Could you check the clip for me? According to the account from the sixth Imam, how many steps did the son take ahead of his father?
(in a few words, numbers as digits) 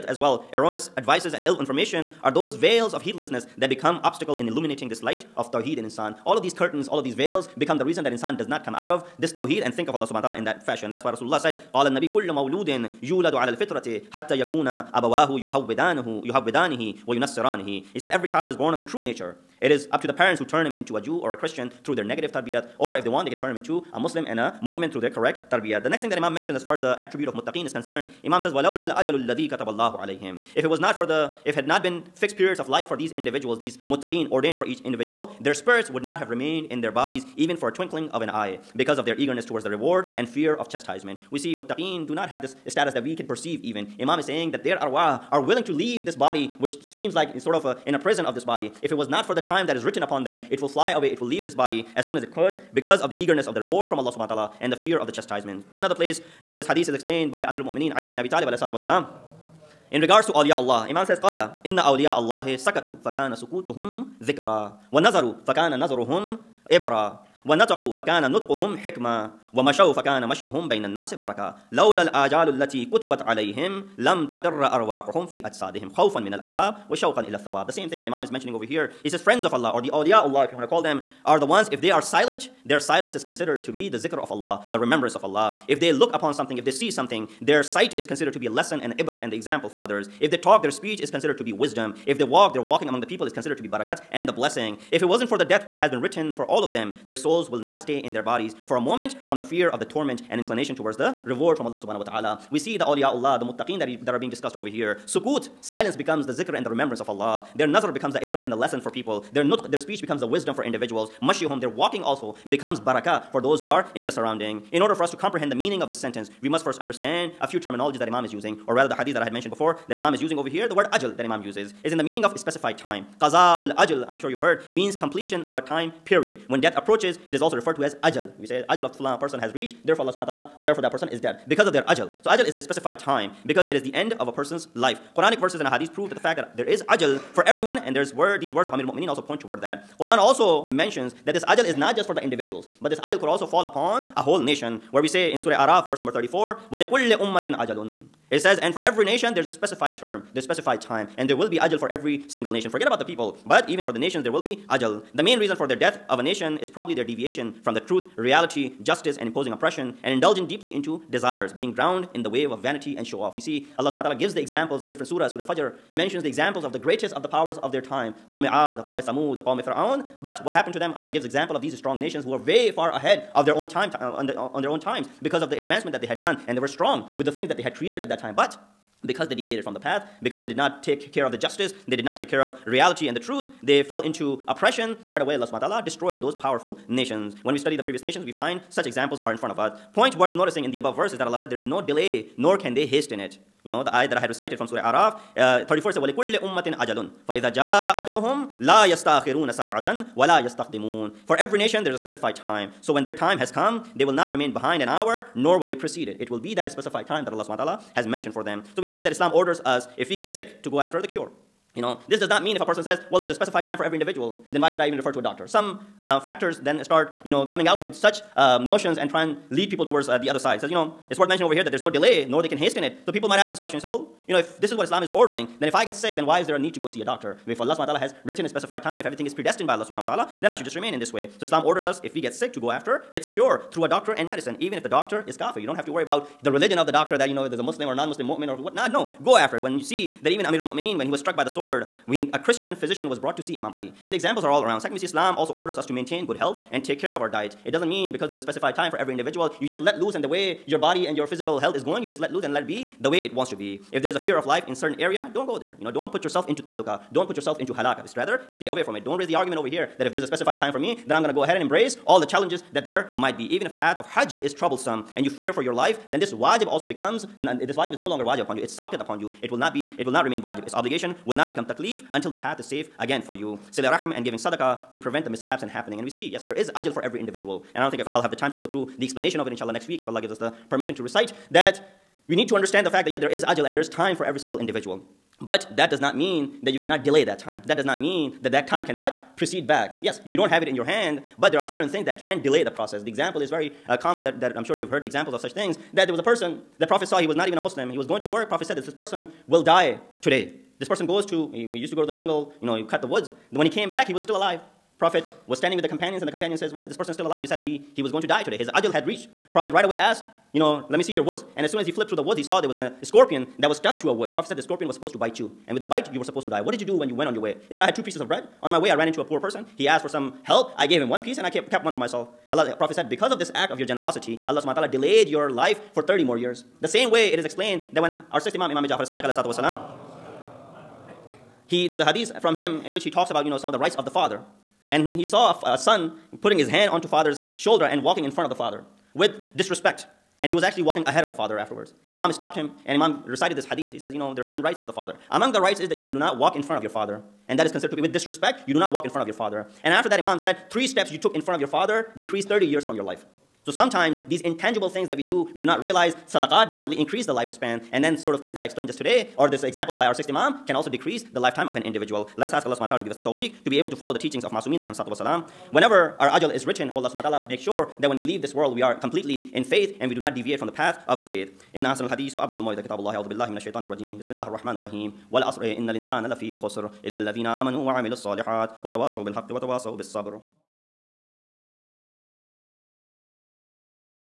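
3.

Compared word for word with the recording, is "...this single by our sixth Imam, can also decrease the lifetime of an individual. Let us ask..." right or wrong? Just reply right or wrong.
wrong.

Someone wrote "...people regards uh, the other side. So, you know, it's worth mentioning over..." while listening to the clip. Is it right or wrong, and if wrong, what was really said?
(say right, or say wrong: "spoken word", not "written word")
wrong: "towards", not "regards".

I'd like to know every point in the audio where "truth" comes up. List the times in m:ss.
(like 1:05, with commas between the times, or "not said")
2:37, 3:03.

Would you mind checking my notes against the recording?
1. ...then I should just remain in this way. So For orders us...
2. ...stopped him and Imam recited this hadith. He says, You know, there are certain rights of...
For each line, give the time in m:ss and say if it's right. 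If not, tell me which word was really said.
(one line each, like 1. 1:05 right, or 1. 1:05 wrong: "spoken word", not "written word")
1. 3:50 wrong: "Islam", not "For"
2. 5:42 right.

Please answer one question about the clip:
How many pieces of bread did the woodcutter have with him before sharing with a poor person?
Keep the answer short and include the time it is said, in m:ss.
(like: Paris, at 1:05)
2, at 5:17.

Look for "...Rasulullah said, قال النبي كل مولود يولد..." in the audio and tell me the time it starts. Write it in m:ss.
0:11.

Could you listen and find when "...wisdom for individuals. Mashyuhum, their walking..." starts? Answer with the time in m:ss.
1:50.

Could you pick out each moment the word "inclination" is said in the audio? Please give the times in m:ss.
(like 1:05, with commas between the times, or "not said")
1:40.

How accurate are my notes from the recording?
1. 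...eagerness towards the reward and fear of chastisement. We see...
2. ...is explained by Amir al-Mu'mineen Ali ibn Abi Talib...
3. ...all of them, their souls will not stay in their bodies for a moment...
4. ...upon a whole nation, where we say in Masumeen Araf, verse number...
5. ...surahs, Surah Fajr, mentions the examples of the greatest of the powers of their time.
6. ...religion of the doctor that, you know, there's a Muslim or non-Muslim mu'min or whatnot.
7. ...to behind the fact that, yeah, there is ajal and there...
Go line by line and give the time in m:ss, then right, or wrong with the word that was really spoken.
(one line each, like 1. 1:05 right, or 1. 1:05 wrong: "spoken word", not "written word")
1. 0:39 right
2. 0:56 right
3. 1:36 right
4. 2:23 wrong: "Surah", not "Masumeen"
5. 2:45 right
6. 3:56 right
7. 4:42 wrong: "understand", not "behind".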